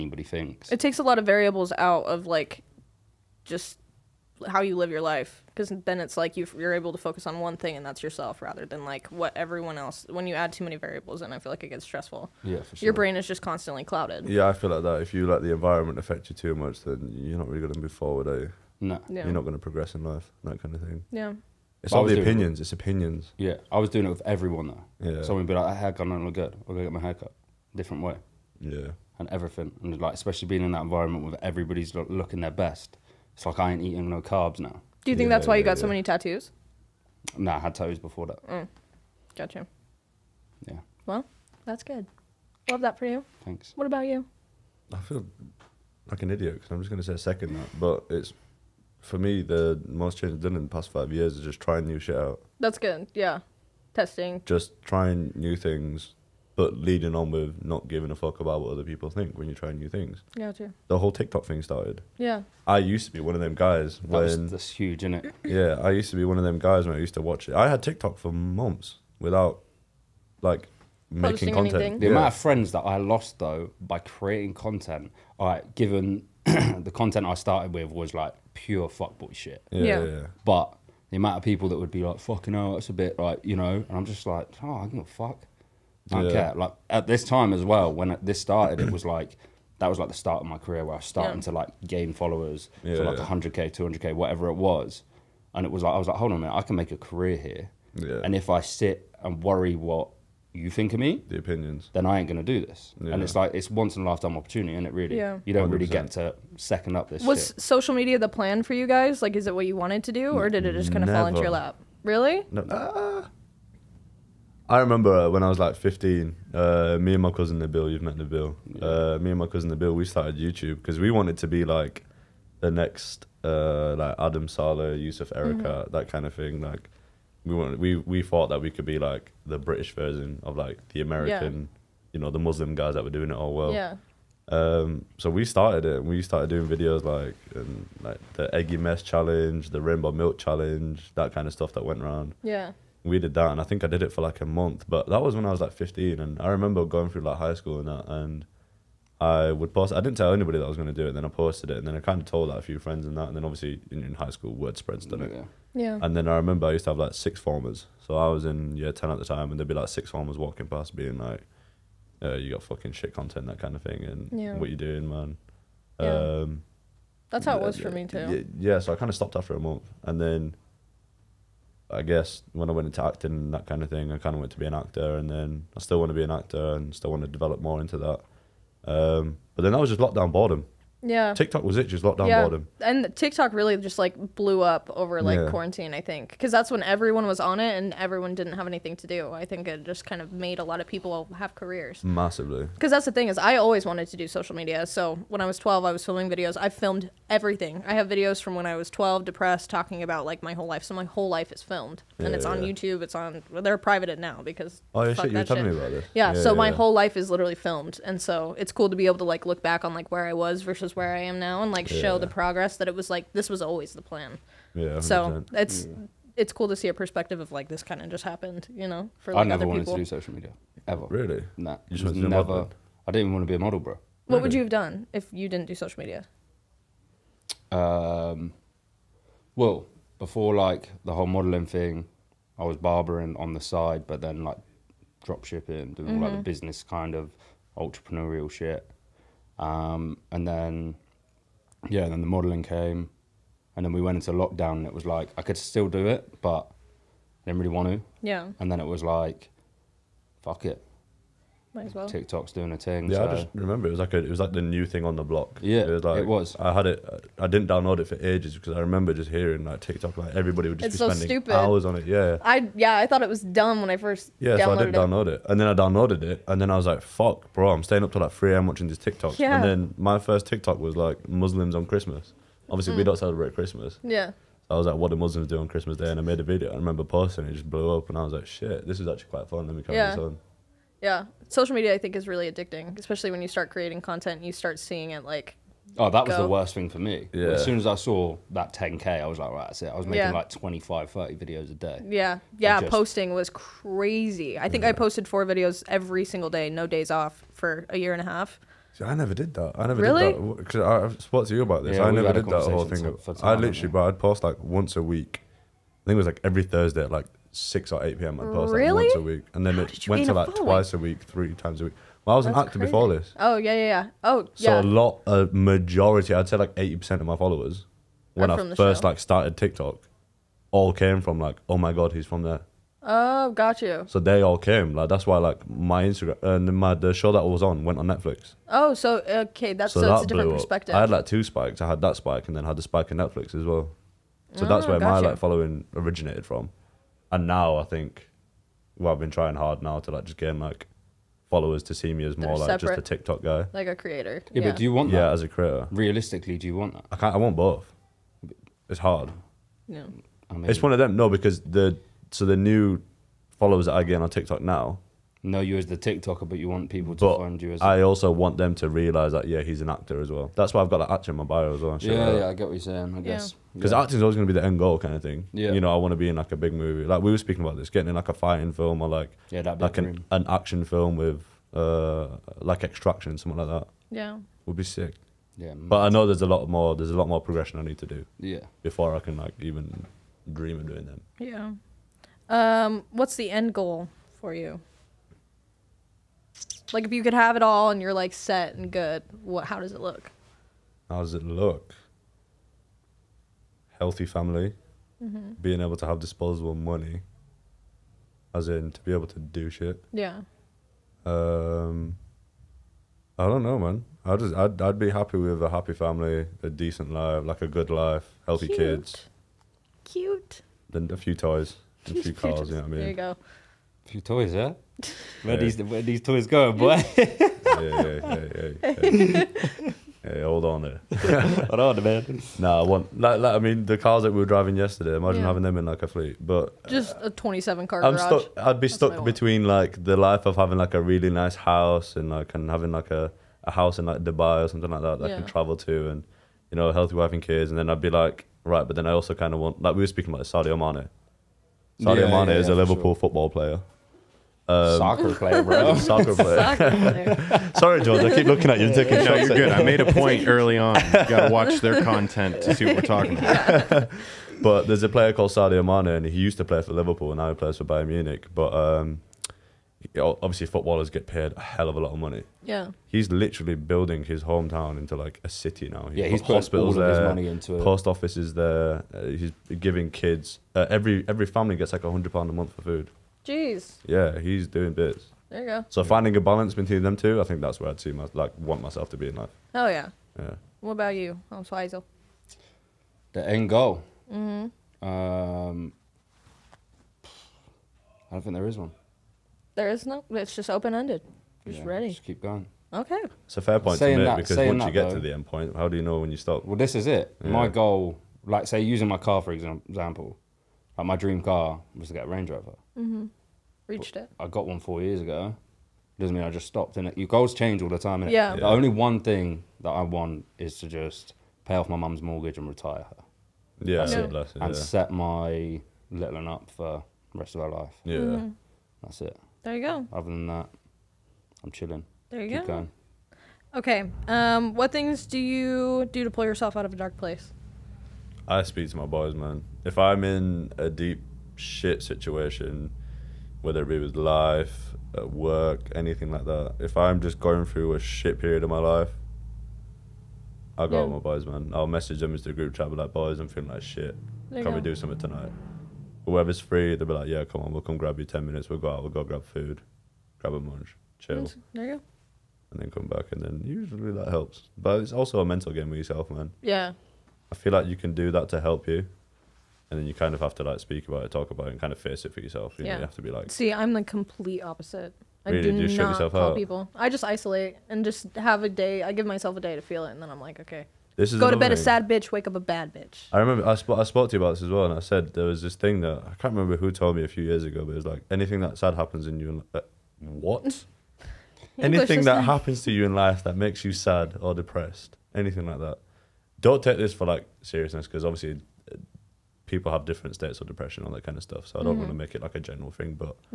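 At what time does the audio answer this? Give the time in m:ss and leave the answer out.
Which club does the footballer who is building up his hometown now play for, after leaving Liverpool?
7:37.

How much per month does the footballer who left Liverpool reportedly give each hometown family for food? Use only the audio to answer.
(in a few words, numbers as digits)
£100.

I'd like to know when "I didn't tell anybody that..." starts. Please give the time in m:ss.
2:29.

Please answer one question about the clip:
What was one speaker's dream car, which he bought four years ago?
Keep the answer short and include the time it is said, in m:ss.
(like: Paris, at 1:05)
Range Rover, at 8:22.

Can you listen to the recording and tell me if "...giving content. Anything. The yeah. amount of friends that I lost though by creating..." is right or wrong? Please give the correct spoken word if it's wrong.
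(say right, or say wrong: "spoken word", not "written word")
wrong: "making", not "giving".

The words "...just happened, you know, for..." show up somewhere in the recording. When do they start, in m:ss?
3:38.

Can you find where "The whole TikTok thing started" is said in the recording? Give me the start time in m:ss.
1:00.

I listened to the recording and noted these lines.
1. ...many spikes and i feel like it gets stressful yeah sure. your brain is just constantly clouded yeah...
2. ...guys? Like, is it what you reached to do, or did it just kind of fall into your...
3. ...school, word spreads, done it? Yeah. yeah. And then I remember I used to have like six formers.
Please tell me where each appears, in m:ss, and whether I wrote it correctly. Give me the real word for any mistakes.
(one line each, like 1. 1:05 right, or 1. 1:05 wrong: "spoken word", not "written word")
1. 0:10 wrong: "variables", not "spikes"
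2. 1:48 wrong: "wanted", not "reached"
3. 2:34 right.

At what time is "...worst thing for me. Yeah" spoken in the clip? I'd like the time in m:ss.
4:46.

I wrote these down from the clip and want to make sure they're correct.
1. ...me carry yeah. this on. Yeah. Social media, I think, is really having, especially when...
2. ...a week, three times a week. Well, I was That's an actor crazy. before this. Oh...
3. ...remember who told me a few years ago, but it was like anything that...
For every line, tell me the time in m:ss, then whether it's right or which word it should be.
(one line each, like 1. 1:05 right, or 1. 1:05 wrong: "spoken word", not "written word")
1. 4:39 wrong: "addicting", not "having"
2. 5:10 right
3. 9:36 right.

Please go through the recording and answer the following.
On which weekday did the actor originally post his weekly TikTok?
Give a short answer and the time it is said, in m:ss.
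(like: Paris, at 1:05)
Thursday, at 5:06.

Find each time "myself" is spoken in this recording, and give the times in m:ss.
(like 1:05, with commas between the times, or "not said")
7:58, 9:29.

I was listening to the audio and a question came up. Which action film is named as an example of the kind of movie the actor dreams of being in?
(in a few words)
Extraction.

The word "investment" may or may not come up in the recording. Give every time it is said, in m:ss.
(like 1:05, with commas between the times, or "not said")
not said.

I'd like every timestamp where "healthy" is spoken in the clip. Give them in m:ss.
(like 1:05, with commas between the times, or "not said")
6:33, 6:48, 7:16.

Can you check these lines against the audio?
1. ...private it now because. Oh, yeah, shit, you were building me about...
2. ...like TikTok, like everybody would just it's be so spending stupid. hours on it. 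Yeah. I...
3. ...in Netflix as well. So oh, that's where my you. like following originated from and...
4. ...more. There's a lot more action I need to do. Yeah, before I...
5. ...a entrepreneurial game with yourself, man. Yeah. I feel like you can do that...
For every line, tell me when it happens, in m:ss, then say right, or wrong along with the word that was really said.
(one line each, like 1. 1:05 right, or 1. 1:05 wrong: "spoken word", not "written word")
1. 3:23 wrong: "telling", not "building"
2. 4:19 right
3. 5:33 right
4. 6:16 wrong: "progression", not "action"
5. 9:15 wrong: "mental", not "entrepreneurial".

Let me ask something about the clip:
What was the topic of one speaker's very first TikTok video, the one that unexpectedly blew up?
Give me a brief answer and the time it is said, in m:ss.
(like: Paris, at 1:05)
Muslims on Christmas, at 4:31.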